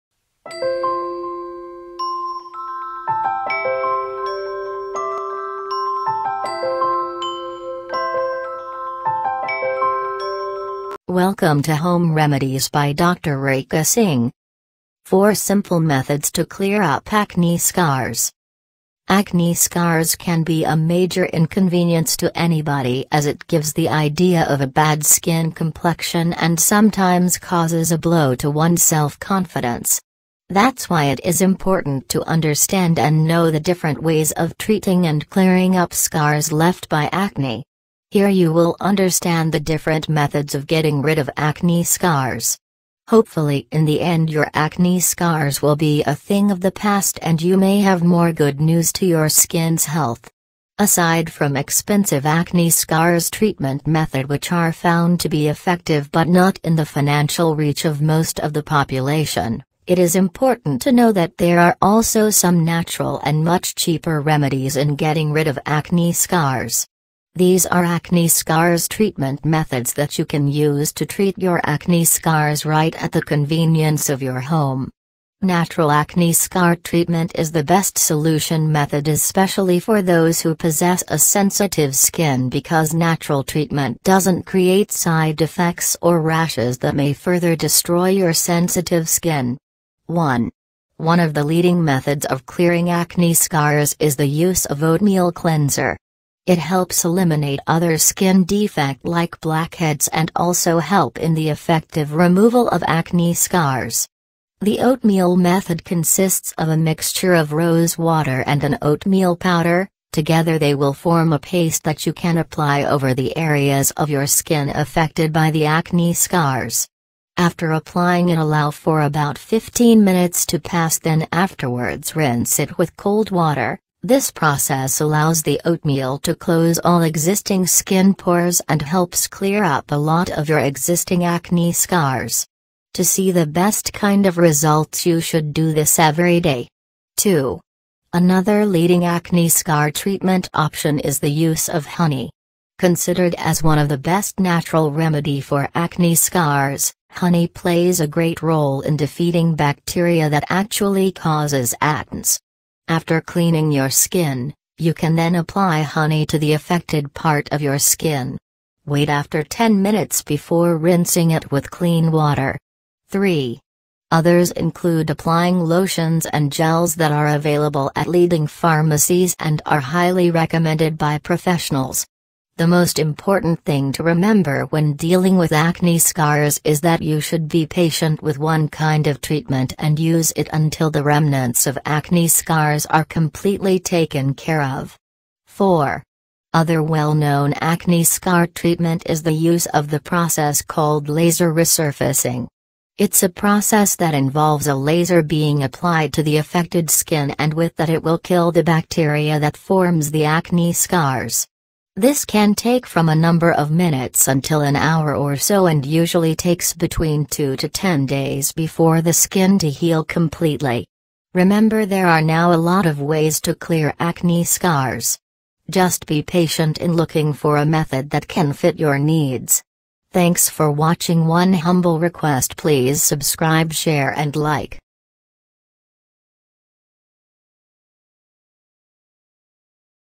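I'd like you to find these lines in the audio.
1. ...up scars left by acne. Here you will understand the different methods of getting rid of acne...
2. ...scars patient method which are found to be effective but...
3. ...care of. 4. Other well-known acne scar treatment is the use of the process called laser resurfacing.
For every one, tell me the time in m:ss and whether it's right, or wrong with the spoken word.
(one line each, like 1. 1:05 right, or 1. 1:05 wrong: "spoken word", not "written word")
1. 0:35 right
2. 0:52 wrong: "treatment", not "patient"
3. 3:04 right.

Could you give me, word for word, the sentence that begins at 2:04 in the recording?
This process allows the oatmeal to close all existing skin pores and helps clear up a lot of your existing acne scars.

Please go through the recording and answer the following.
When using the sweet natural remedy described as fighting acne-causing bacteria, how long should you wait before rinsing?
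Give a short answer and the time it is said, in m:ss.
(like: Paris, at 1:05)
10 minutes, at 2:39.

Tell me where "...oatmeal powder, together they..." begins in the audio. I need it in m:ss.
1:48.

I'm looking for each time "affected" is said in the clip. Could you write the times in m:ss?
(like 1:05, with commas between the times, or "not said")
1:54, 2:36, 3:16.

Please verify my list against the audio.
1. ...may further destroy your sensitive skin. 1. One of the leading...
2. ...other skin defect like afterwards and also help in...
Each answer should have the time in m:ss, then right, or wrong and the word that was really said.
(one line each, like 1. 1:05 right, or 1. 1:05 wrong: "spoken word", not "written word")
1. 1:26 right
2. 1:37 wrong: "blackheads", not "afterwards".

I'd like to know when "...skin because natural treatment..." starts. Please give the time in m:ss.
1:21.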